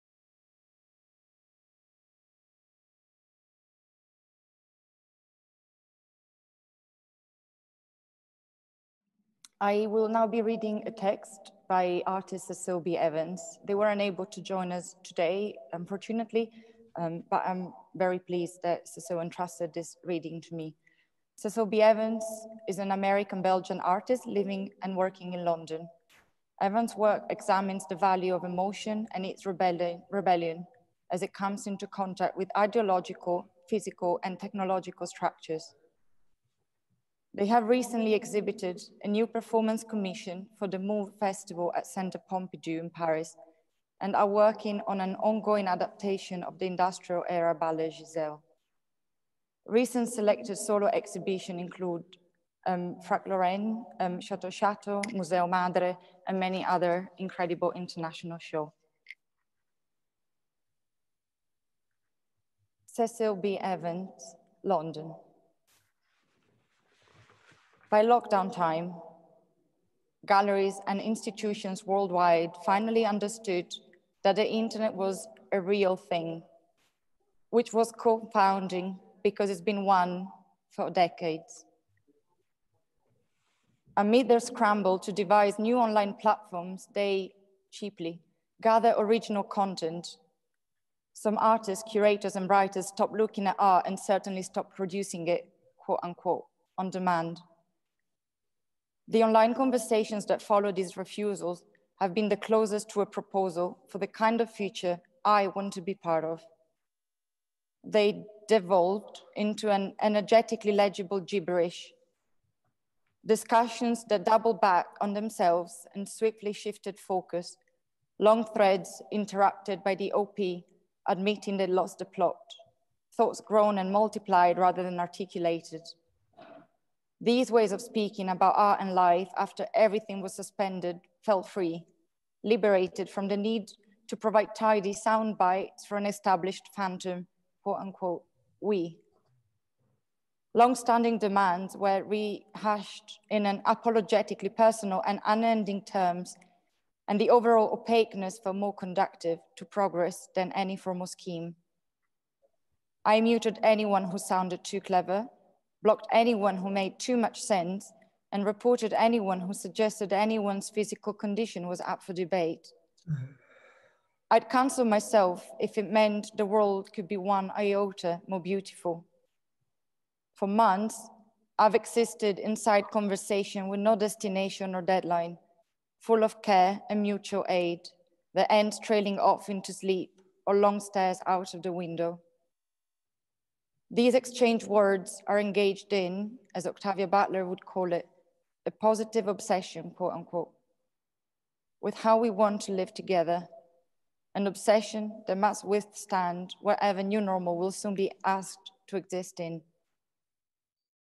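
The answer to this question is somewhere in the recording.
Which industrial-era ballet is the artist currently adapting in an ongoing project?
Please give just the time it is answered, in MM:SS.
00:47.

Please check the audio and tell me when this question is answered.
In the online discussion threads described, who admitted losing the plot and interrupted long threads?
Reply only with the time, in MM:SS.
02:00.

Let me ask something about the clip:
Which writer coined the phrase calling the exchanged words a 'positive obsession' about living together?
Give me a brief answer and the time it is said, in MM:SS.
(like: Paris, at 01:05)
Octavia Butler, at 03:06.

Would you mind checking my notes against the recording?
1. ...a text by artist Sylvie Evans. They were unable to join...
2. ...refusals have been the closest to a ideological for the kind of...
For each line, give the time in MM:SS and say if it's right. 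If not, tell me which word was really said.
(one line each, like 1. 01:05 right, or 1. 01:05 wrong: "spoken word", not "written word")
1. 00:10 right
2. 01:40 wrong: "proposal", not "ideological".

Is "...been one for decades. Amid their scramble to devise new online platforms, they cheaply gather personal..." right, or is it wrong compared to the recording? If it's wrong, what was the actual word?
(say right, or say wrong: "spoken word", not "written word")
wrong: "original", not "personal".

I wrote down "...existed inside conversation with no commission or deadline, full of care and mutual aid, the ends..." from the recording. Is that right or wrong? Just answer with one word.
wrong.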